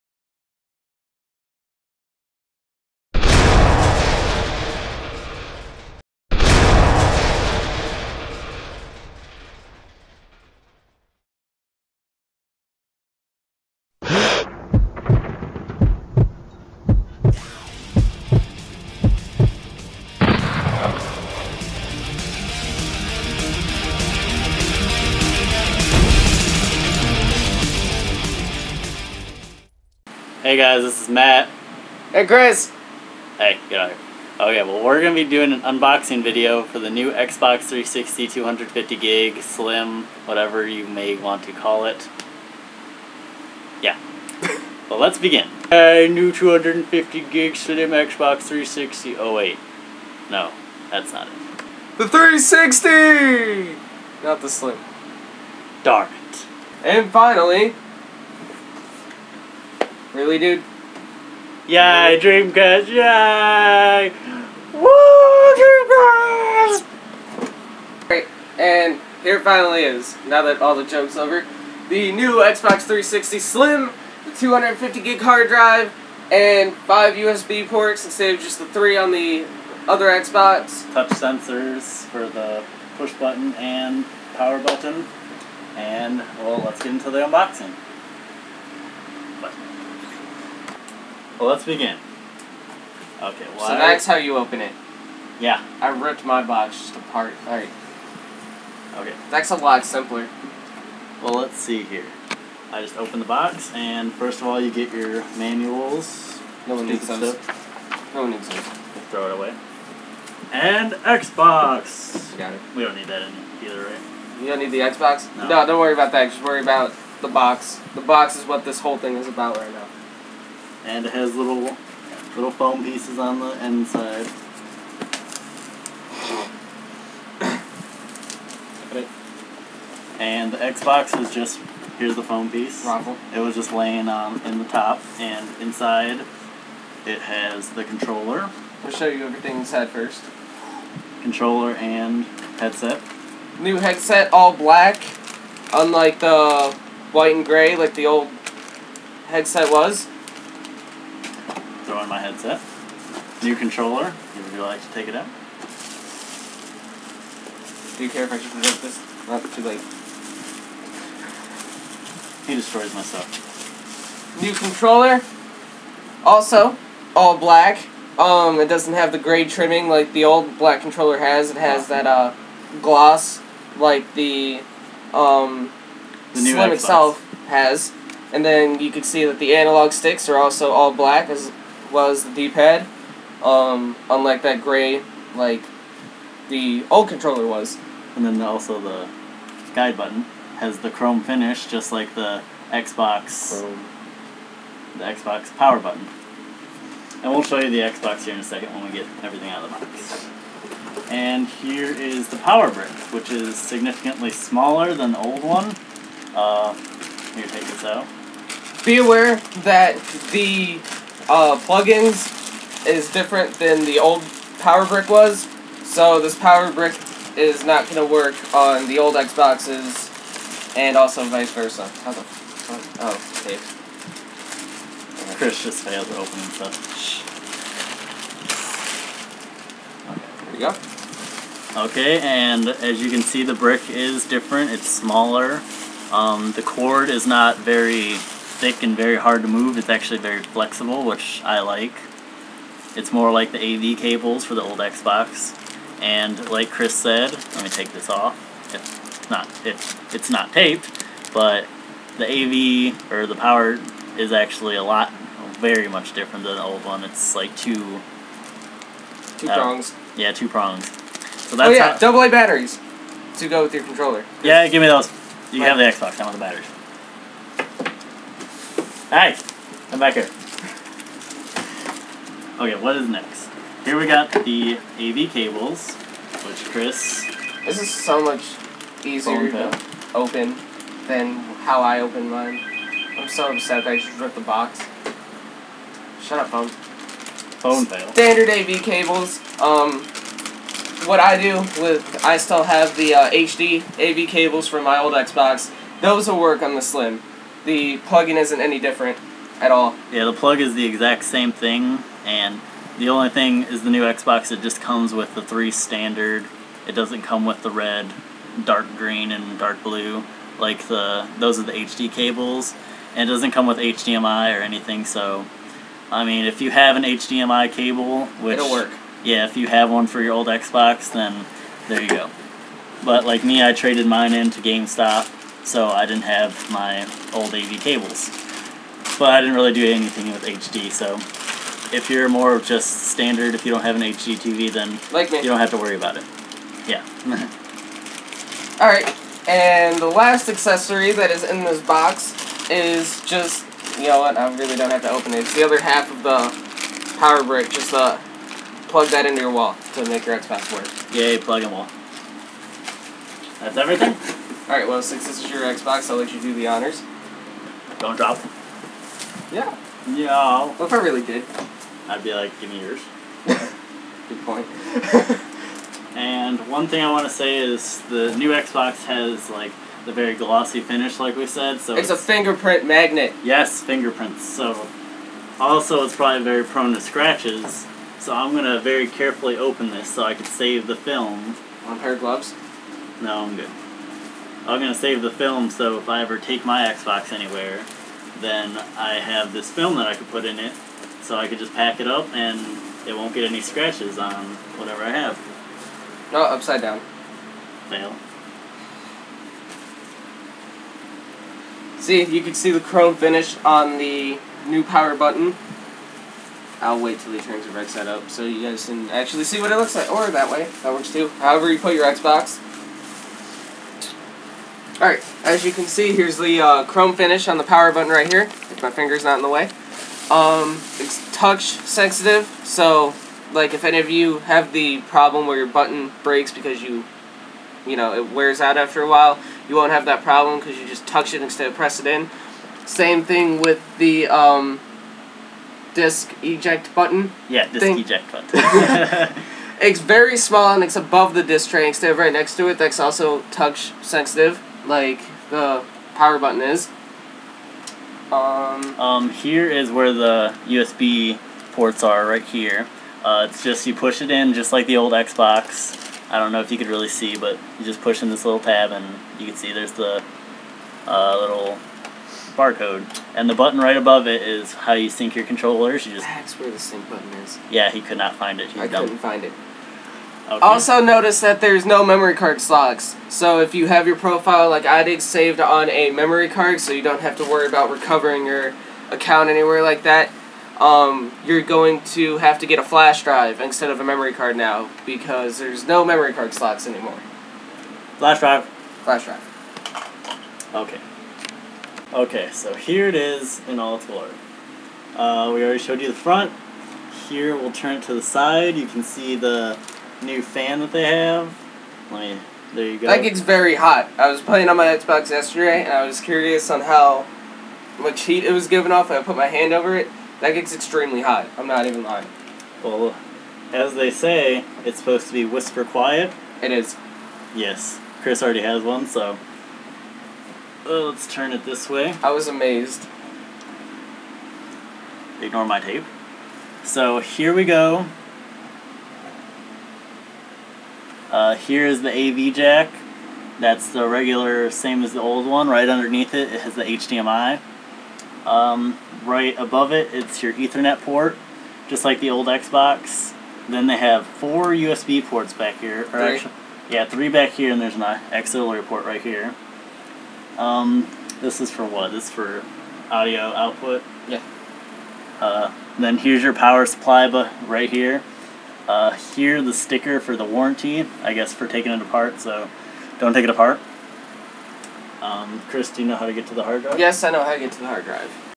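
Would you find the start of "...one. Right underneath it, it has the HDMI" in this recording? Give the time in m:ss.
8:55.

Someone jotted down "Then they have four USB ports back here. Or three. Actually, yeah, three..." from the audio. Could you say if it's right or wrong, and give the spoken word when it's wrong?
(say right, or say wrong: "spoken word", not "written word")
right.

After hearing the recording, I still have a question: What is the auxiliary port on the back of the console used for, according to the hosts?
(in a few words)
Audio output.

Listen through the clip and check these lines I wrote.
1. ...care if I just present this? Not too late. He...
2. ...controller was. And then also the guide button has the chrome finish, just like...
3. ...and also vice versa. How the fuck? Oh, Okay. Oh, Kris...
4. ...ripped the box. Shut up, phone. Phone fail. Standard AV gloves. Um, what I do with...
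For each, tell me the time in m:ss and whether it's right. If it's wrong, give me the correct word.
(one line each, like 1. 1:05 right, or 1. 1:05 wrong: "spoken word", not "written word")
1. 2:38 right
2. 3:07 right
3. 3:40 right
4. 4:44 wrong: "cables", not "gloves".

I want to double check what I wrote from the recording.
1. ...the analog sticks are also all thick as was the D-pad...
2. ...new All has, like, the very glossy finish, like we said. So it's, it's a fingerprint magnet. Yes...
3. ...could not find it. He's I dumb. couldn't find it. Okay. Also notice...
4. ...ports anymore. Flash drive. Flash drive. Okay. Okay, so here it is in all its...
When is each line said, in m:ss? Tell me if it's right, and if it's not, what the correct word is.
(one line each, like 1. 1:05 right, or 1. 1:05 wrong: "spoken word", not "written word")
1. 2:59 wrong: "black", not "thick"
2. 6:08 wrong: "Xbox", not "All"
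3. 7:47 right
4. 8:06 wrong: "slots", not "ports".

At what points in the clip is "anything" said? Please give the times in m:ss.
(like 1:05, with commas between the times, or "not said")
5:14, 5:29.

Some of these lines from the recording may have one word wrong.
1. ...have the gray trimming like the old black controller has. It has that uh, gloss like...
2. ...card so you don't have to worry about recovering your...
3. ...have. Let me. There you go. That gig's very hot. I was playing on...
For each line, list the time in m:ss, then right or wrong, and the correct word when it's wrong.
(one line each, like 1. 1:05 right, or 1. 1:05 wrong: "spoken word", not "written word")
1. 2:48 right
2. 7:56 right
3. 8:21 right.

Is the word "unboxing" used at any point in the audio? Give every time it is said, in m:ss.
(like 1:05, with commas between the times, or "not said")
0:35, 1:27.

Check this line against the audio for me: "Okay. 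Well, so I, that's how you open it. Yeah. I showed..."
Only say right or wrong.
wrong.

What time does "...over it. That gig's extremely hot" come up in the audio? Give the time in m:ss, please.
8:29.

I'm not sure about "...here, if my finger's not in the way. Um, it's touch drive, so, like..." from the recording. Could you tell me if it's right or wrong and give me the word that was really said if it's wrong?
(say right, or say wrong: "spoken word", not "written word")
wrong: "sensitive", not "drive".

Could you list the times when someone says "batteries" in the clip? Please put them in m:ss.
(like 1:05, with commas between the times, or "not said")
4:22, 4:26.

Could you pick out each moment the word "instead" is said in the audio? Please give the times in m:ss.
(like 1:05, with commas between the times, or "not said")
1:18, 7:11, 7:21, 8:03.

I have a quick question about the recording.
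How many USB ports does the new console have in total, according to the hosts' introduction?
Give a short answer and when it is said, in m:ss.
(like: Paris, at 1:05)
5, at 1:16.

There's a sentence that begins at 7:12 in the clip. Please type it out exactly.
Same thing with the, um, disk eject button.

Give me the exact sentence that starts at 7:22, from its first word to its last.
That's also touch sensitive like the power button is.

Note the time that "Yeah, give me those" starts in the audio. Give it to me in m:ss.
4:24.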